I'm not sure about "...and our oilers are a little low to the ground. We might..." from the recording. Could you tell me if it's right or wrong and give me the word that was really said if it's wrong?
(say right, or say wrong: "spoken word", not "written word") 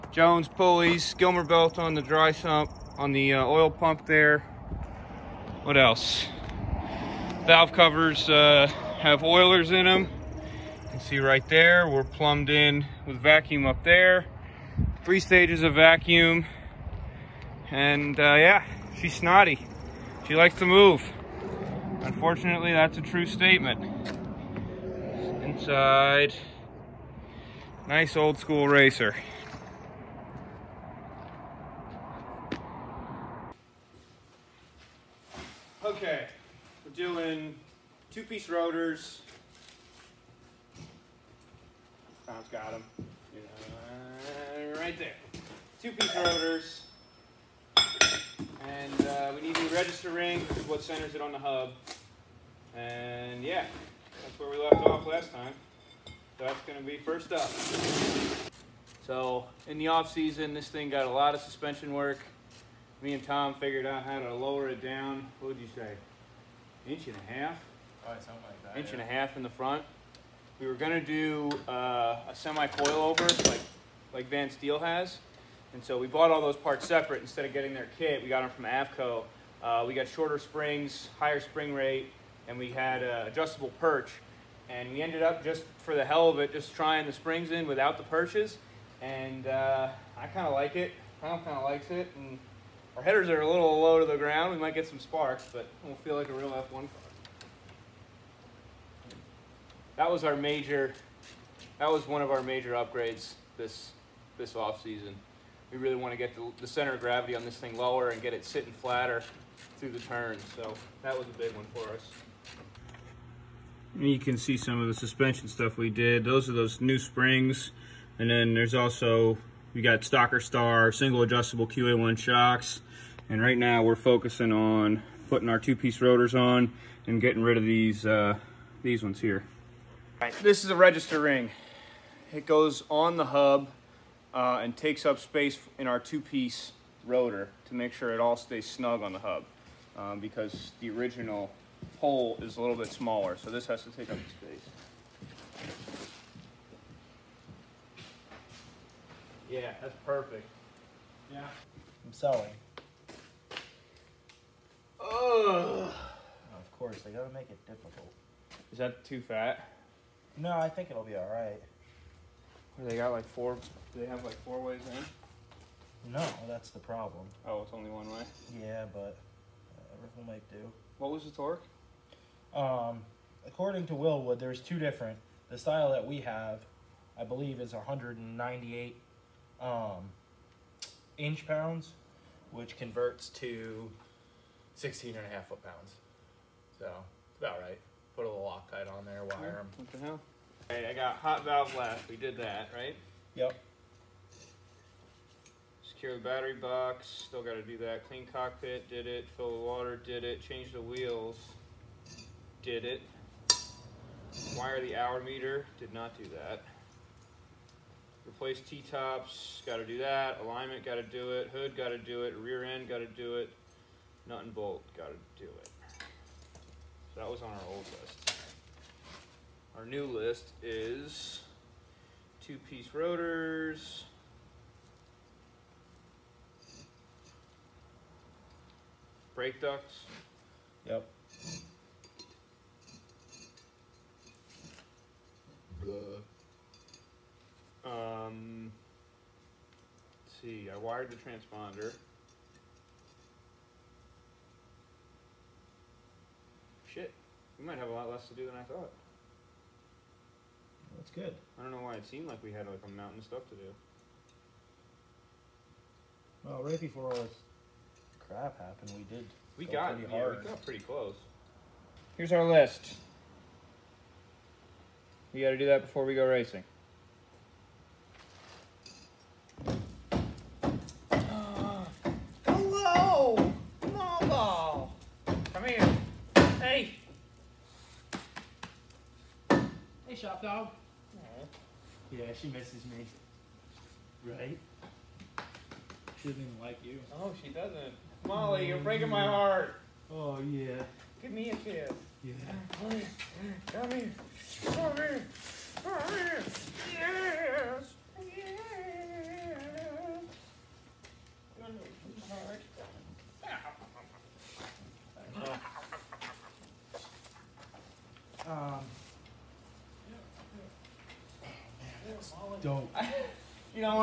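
wrong: "headers", not "oilers".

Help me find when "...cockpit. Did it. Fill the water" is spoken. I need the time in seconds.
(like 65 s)
198 s.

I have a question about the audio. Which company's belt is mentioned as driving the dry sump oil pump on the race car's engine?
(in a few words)
Gilmer.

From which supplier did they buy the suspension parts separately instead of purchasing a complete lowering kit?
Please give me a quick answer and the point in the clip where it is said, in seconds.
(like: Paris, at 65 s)
AFCO, at 78 s.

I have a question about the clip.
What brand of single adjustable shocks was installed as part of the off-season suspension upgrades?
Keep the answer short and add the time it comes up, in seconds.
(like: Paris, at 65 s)
QA1, at 121 s.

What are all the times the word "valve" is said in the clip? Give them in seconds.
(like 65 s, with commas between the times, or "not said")
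7 s, 191 s.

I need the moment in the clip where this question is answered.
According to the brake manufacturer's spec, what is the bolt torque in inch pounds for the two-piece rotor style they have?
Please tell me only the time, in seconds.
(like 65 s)
177 s.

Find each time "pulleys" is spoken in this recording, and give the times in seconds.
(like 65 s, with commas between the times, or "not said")
0 s.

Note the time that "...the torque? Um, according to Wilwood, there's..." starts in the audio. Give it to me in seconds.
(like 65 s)
171 s.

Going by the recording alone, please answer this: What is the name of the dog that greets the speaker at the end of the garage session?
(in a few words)
Molly.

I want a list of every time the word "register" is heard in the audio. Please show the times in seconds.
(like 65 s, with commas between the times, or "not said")
49 s, 130 s.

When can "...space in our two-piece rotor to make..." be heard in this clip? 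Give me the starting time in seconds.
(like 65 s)
135 s.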